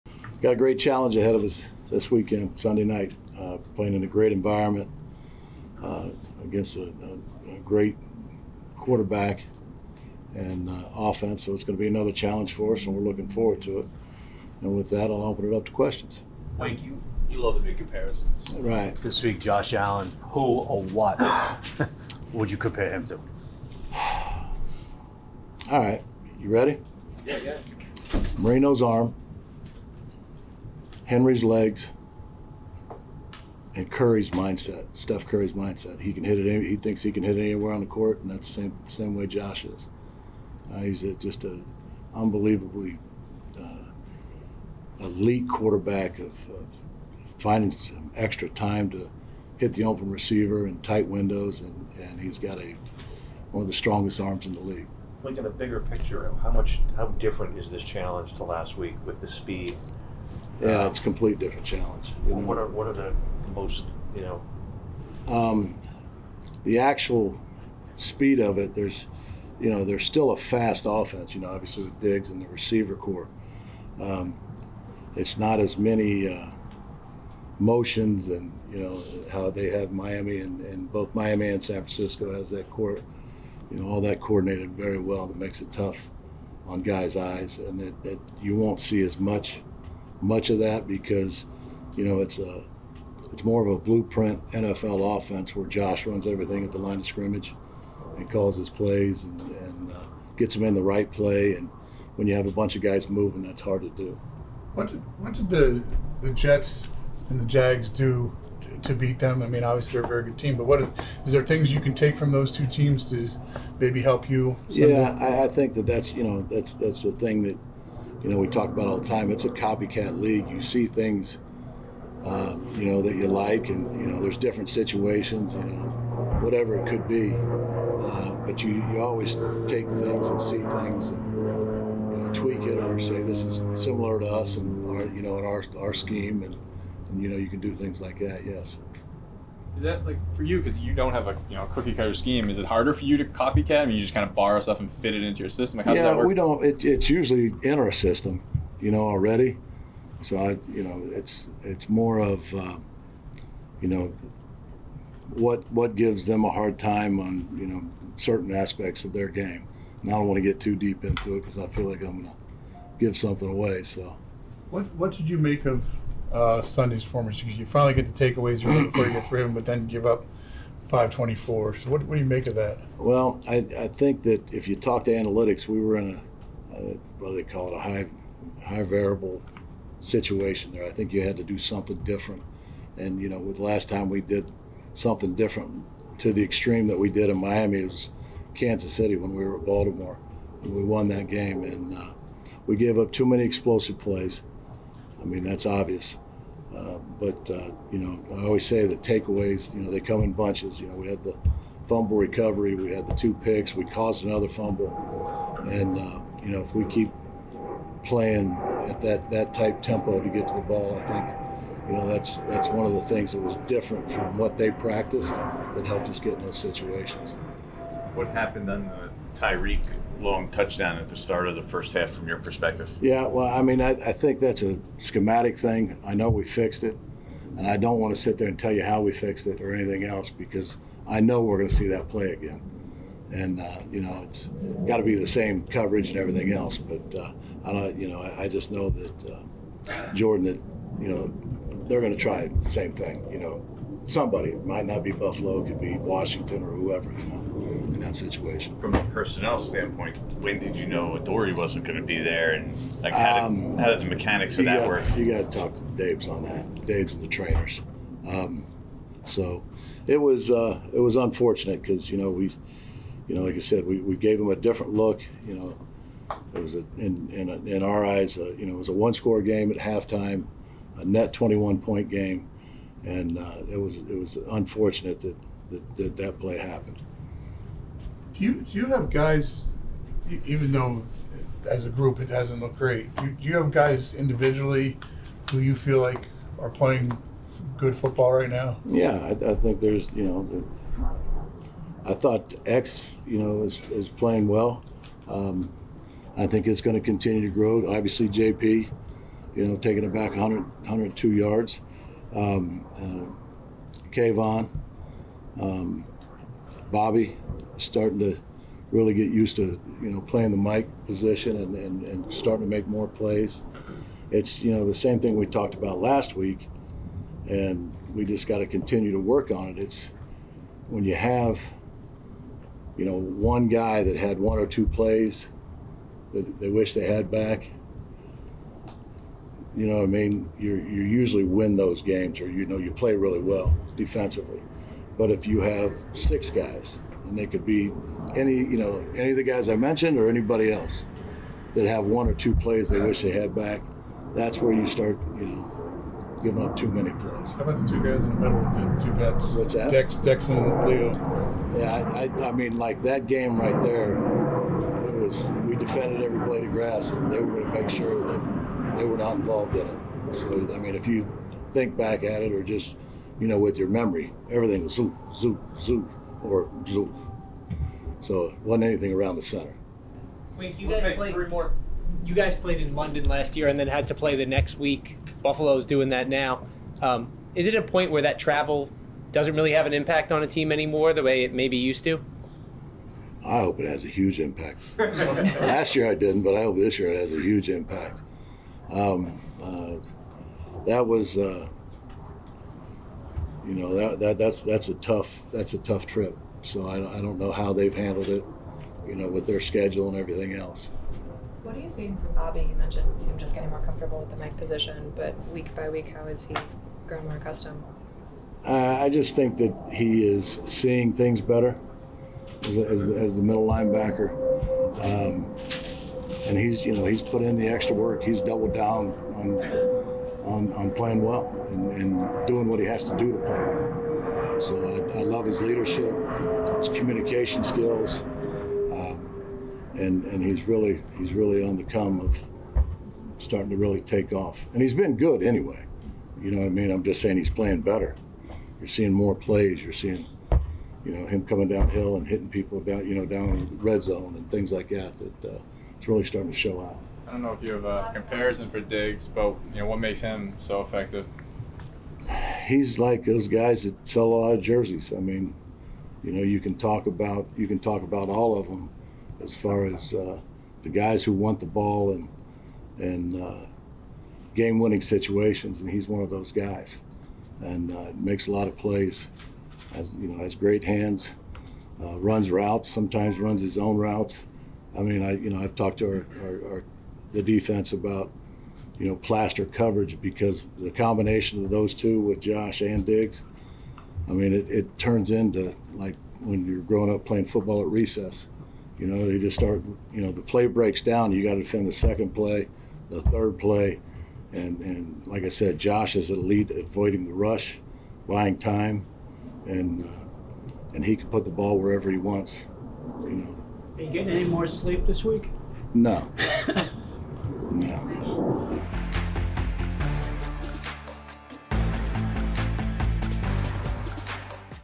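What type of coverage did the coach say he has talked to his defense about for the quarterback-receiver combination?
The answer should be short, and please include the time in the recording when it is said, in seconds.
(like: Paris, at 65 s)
plaster coverage, at 479 s.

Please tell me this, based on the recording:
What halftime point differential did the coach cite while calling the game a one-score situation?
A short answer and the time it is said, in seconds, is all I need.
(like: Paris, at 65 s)
21, at 271 s.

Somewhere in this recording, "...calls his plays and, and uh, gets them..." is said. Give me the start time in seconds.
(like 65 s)
98 s.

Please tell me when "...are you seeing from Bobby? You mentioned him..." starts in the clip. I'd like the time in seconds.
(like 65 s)
401 s.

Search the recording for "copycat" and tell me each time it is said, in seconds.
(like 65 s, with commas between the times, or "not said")
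119 s, 143 s.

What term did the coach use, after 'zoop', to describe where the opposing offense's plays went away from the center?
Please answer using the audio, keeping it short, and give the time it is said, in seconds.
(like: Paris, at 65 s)
Zulu, at 366 s.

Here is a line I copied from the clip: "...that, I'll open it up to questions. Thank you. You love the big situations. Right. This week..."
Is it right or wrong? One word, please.
wrong.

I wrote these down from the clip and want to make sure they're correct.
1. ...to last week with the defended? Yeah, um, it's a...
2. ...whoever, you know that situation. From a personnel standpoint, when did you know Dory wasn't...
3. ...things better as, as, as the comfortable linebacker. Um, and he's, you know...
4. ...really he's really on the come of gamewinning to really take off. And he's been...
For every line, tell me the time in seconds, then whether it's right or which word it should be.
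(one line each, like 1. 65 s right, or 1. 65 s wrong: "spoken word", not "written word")
1. 58 s wrong: "speed", not "defended"
2. 246 s right
3. 411 s wrong: "middle", not "comfortable"
4. 430 s wrong: "starting", not "gamewinning".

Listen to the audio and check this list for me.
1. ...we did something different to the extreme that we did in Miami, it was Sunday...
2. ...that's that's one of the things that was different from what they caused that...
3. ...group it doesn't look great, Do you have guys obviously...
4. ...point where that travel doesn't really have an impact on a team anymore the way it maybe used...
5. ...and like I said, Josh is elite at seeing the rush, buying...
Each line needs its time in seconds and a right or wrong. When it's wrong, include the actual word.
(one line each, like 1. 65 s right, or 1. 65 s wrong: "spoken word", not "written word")
1. 184 s wrong: "Kansas", not "Sunday"
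2. 212 s wrong: "practiced", not "caused"
3. 281 s wrong: "individually", not "obviously"
4. 377 s right
5. 494 s wrong: "avoiding", not "seeing".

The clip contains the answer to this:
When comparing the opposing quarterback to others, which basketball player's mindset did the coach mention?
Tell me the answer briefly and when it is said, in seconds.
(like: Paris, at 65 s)
Steph Curry, at 34 s.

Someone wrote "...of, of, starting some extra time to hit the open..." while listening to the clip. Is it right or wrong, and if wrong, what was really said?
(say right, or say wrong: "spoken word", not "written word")
wrong: "finding", not "starting".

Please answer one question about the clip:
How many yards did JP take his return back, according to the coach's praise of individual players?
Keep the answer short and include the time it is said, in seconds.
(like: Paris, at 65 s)
102, at 300 s.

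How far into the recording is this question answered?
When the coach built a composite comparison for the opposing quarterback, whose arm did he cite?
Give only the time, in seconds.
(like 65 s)
28 s.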